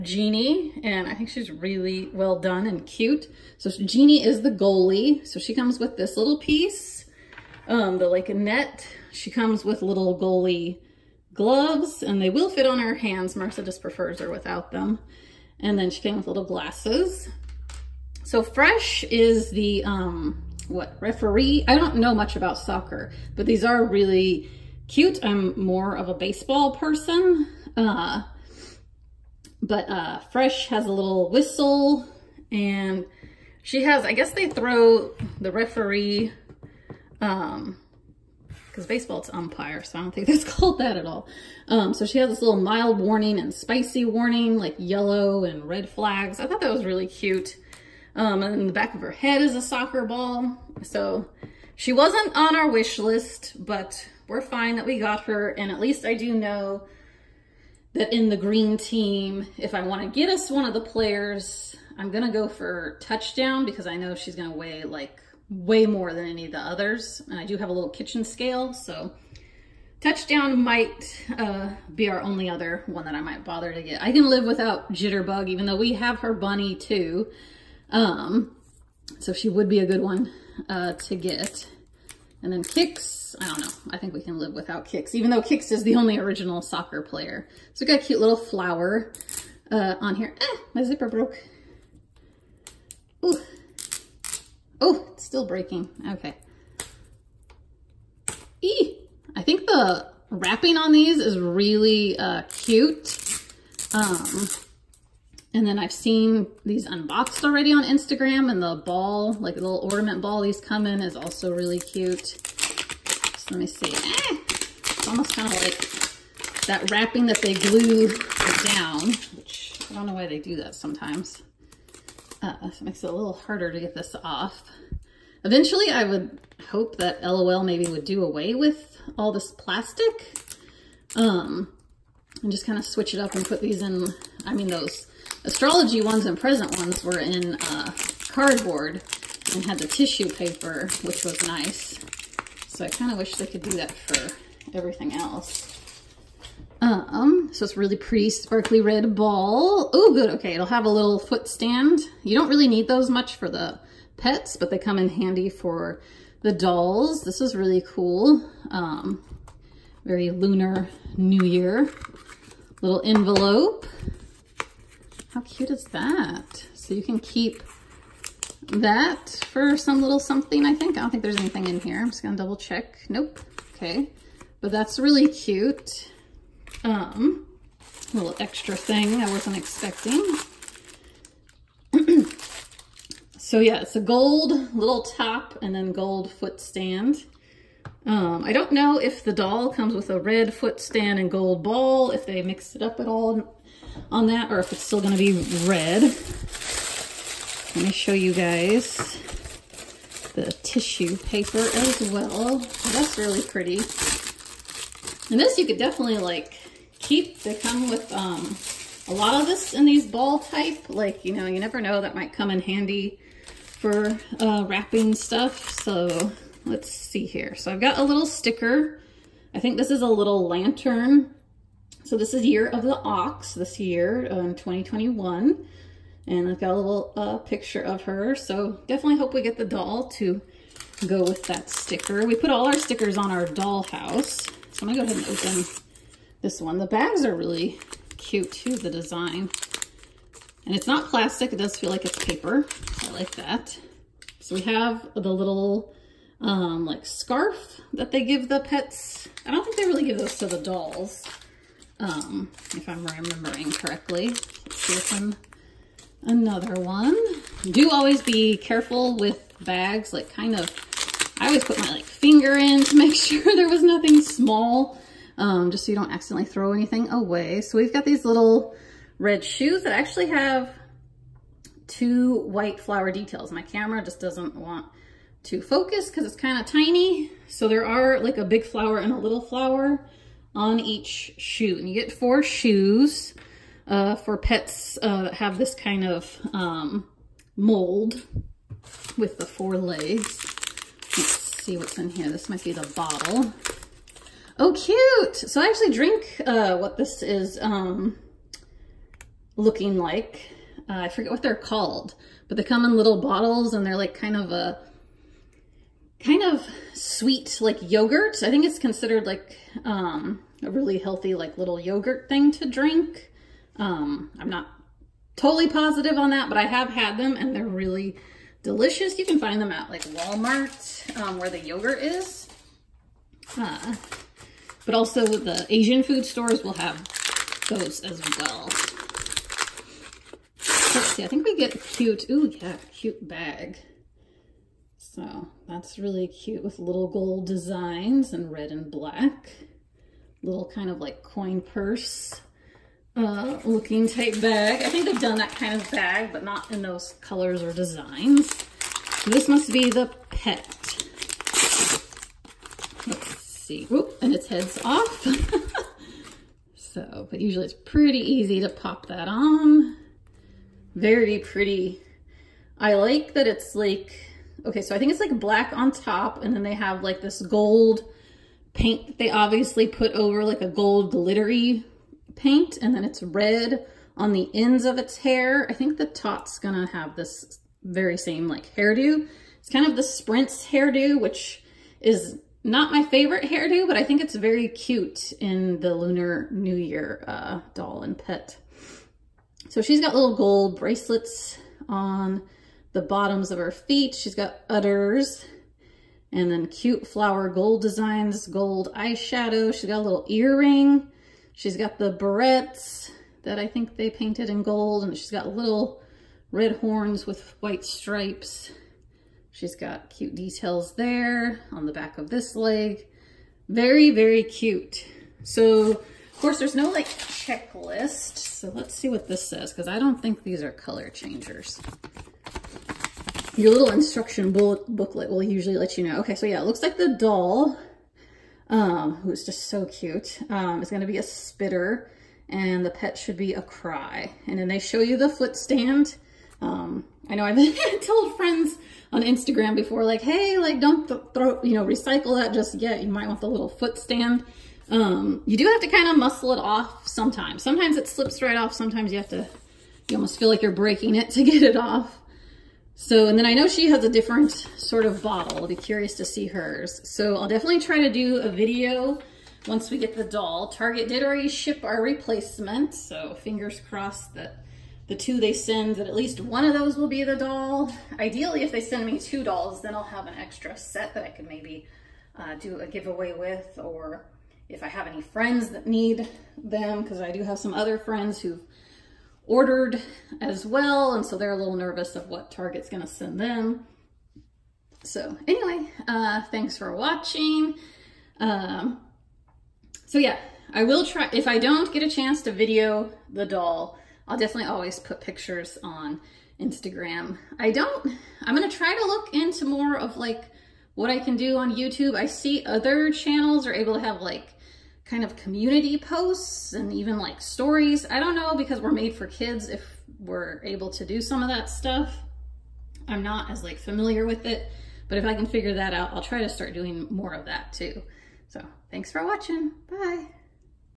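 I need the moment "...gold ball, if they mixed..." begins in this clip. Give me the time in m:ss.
3:11.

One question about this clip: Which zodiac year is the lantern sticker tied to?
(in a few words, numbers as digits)
Year of the Ox.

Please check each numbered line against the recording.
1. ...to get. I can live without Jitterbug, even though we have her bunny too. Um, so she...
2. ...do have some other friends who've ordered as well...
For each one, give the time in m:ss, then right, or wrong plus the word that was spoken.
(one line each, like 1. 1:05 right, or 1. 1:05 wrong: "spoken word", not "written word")
1. 1:13 right
2. 7:57 right.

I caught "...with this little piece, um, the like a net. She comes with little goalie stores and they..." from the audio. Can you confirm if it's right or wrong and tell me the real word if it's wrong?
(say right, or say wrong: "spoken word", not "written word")
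wrong: "gloves", not "stores".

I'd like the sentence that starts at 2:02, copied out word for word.
Uh, so it makes it a little harder to get this off.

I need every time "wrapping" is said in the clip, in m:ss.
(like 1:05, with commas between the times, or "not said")
1:40, 1:56, 3:34.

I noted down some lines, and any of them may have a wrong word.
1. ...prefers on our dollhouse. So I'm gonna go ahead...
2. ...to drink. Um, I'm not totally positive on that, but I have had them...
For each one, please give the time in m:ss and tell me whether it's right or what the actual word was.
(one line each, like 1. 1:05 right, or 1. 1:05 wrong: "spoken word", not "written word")
1. 3:52 wrong: "stickers", not "prefers"
2. 5:12 right.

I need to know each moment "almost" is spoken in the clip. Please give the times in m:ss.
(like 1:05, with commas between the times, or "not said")
1:55, 7:30.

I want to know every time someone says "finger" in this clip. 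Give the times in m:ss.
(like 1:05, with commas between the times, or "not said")
4:22, 7:43.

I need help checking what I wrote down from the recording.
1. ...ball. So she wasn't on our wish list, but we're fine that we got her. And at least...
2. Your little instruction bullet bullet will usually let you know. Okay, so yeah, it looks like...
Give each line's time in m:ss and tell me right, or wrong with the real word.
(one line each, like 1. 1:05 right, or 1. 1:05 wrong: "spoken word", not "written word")
1. 0:50 right
2. 7:03 wrong: "booklet", not "bullet".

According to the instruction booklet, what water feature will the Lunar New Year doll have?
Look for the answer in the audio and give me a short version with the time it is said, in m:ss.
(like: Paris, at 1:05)
Spitter, at 7:11.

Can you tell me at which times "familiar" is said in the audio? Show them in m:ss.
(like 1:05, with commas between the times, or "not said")
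8:33.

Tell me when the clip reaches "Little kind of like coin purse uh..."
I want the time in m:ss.
5:40.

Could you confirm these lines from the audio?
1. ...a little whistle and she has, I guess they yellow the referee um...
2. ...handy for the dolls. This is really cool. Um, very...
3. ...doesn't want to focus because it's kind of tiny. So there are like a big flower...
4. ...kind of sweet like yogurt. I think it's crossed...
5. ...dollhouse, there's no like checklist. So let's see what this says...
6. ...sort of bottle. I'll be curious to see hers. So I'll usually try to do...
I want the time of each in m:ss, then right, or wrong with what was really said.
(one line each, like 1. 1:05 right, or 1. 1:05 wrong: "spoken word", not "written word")
1. 0:30 wrong: "throw", not "yellow"
2. 2:35 right
3. 4:34 right
4. 5:06 wrong: "considered", not "crossed"
5. 6:56 wrong: "course", not "dollhouse"
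6. 7:34 wrong: "definitely", not "usually".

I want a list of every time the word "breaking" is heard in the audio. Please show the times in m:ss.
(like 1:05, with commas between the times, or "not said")
1:35, 7:30.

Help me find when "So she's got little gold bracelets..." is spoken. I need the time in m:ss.
6:29.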